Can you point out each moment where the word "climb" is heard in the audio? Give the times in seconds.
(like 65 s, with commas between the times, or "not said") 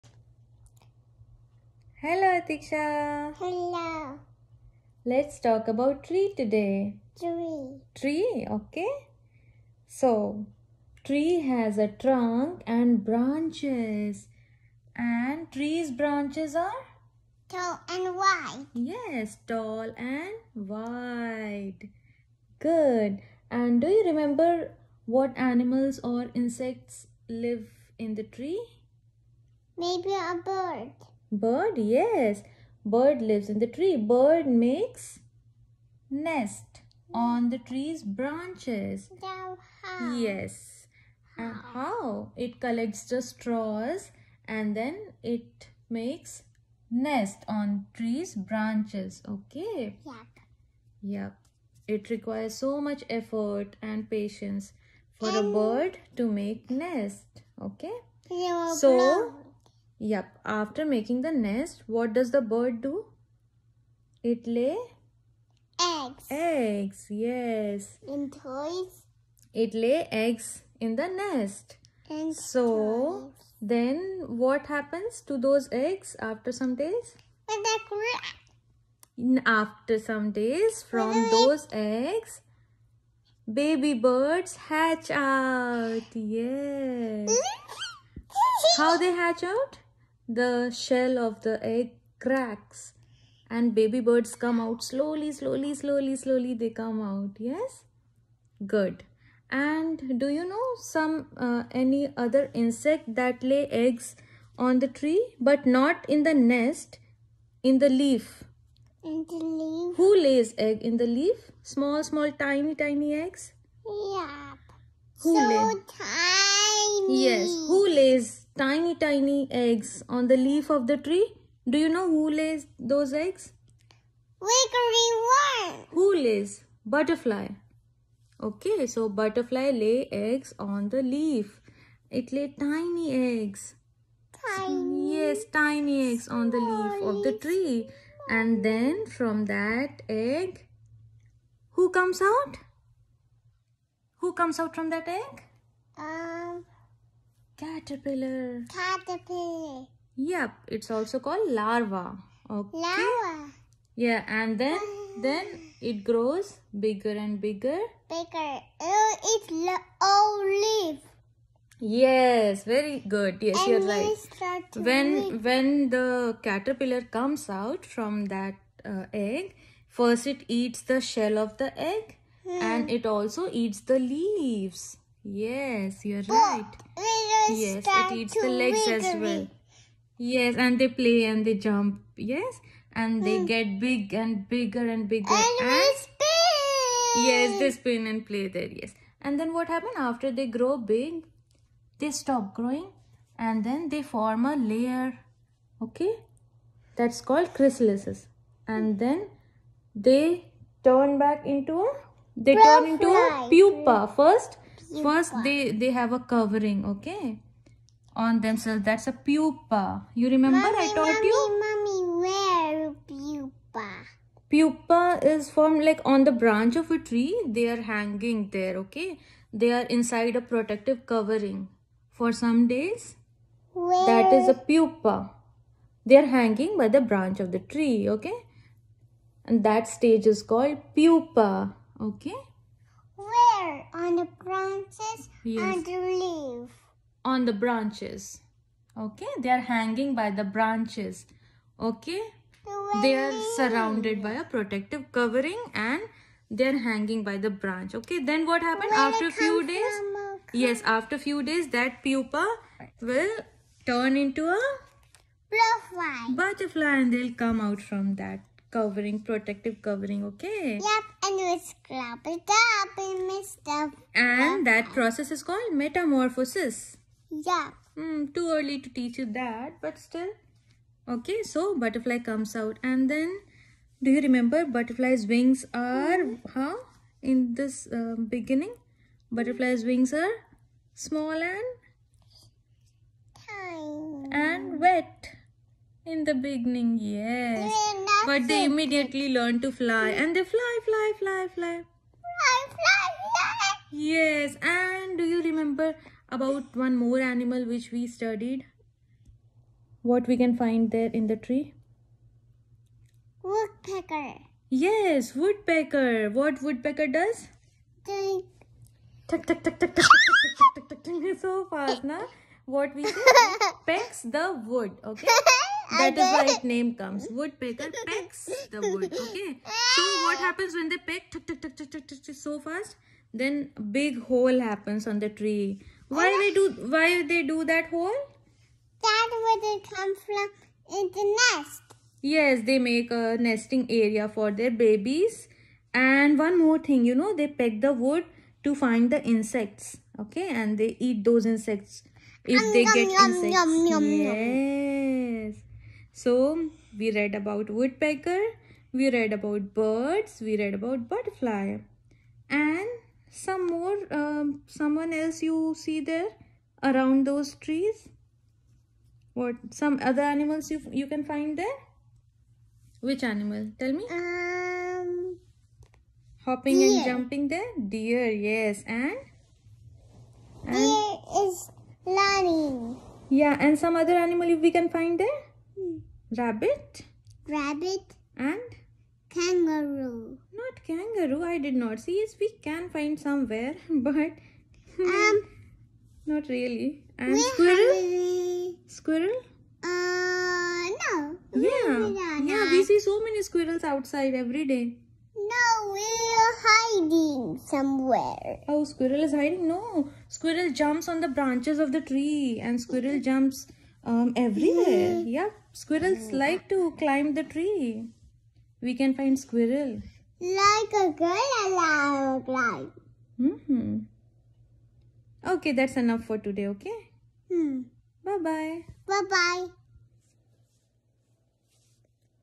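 406 s, 412 s.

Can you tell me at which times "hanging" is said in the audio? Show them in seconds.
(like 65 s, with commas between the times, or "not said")
217 s, 226 s, 239 s, 246 s.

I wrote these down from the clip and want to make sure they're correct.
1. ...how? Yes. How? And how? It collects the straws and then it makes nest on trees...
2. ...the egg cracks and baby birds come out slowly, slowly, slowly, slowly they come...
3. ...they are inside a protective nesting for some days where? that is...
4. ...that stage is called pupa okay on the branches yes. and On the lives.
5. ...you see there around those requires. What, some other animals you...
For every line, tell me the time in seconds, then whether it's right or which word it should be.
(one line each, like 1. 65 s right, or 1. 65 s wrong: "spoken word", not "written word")
1. 39 s right
2. 91 s right
3. 219 s wrong: "covering", not "nesting"
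4. 229 s wrong: "branches", not "lives"
5. 355 s wrong: "trees", not "requires".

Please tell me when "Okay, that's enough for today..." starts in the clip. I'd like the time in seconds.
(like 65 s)
415 s.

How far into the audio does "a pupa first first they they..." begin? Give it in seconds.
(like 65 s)
203 s.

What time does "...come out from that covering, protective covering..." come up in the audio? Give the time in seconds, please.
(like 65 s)
257 s.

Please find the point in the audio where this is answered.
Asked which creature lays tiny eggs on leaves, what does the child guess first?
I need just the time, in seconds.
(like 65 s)
124 s.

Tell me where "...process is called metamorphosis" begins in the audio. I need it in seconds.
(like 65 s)
264 s.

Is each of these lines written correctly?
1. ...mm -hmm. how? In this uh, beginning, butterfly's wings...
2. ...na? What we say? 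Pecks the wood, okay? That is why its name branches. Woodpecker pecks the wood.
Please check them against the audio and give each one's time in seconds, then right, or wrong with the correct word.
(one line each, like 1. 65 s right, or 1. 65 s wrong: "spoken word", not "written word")
1. 276 s right
2. 312 s wrong: "comes", not "branches".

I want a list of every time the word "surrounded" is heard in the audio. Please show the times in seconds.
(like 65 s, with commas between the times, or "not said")
243 s.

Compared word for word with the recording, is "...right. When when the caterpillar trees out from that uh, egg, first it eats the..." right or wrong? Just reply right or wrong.
wrong.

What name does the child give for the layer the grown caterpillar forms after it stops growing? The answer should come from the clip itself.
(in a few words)
Chrysalises.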